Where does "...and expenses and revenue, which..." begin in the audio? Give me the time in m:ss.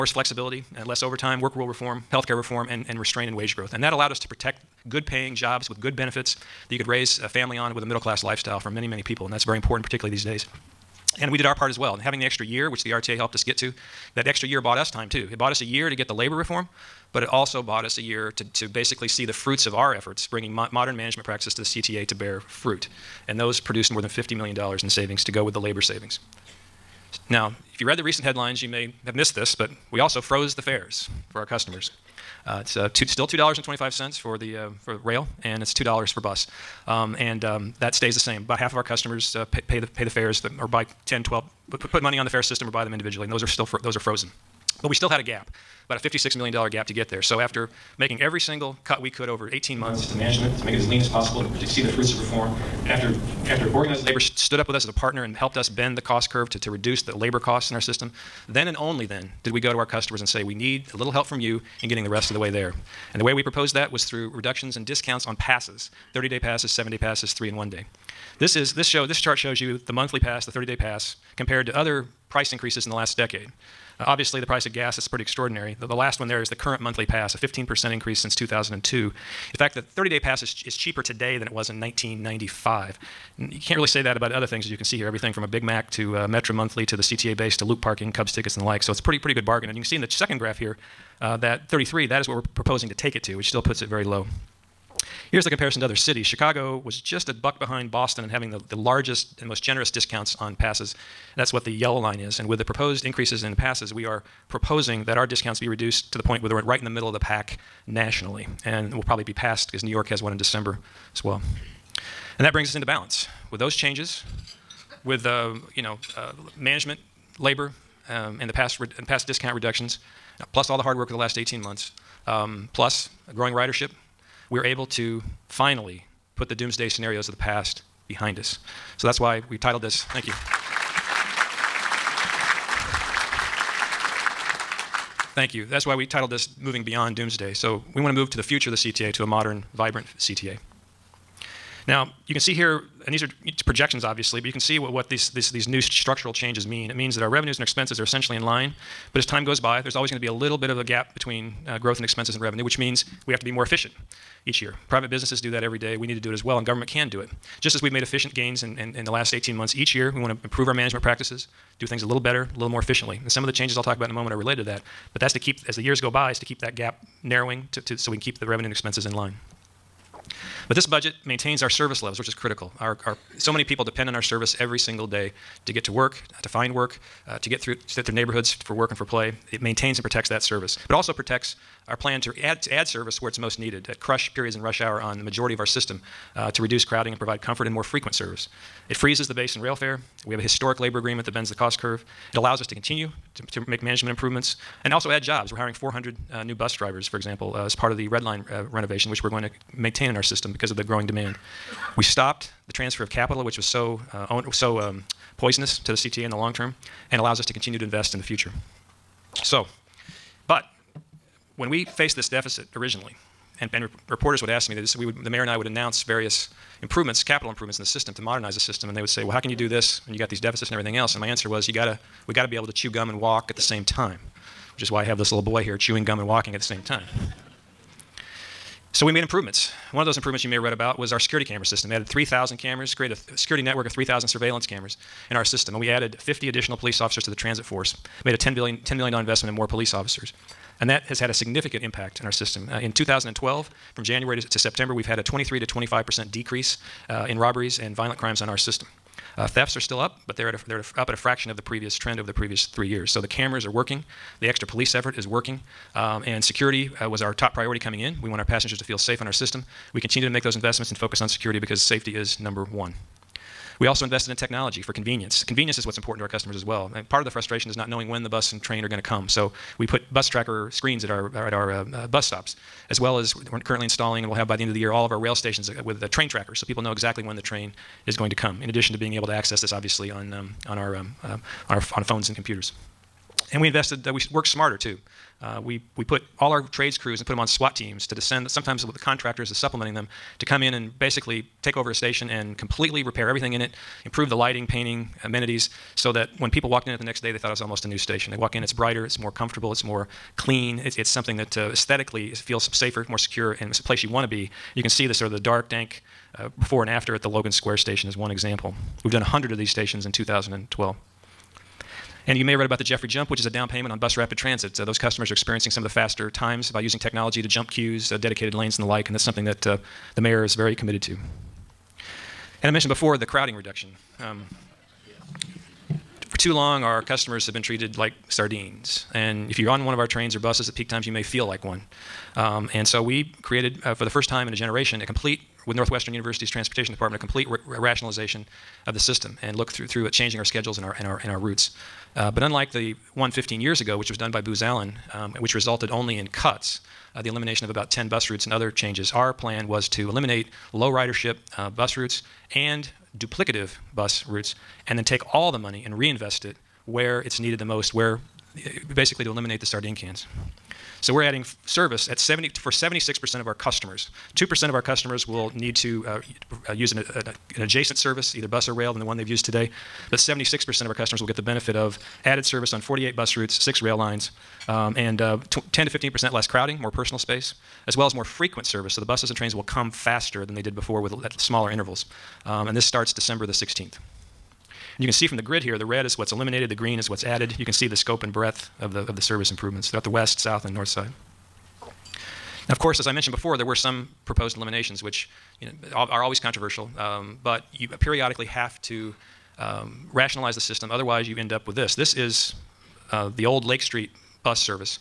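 2:31.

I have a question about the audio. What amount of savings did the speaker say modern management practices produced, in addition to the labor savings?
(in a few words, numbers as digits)
more than $50 million.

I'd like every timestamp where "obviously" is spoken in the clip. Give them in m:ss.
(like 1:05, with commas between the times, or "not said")
1:14, 2:24, 4:39.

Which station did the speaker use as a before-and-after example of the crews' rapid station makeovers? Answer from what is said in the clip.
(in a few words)
Logan Square.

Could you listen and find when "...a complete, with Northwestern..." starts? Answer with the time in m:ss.
5:35.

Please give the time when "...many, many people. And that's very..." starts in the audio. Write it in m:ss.
0:08.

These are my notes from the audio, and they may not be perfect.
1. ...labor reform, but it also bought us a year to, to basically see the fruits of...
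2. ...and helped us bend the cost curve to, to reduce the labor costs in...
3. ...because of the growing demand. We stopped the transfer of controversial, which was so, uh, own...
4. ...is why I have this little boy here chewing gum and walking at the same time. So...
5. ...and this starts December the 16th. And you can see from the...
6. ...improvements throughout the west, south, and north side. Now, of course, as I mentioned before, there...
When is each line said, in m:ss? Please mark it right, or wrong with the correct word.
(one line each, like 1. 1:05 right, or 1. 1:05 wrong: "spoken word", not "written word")
1. 0:16 right
2. 0:55 right
3. 3:20 wrong: "capital", not "controversial"
4. 3:44 right
5. 6:22 right
6. 6:29 right.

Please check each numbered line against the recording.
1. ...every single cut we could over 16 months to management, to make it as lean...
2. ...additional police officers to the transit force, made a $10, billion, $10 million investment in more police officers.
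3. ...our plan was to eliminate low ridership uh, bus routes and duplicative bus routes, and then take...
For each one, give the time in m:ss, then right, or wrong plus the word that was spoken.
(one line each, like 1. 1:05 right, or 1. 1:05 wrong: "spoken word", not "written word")
1. 0:48 wrong: "18", not "16"
2. 3:56 right
3. 5:49 right.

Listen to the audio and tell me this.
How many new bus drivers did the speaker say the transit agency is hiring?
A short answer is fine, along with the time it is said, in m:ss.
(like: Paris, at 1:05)
400, at 3:15.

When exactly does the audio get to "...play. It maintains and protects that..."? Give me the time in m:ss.
2:59.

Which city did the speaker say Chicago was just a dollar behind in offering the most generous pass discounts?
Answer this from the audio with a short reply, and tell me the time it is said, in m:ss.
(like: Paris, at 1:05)
Boston, at 1:37.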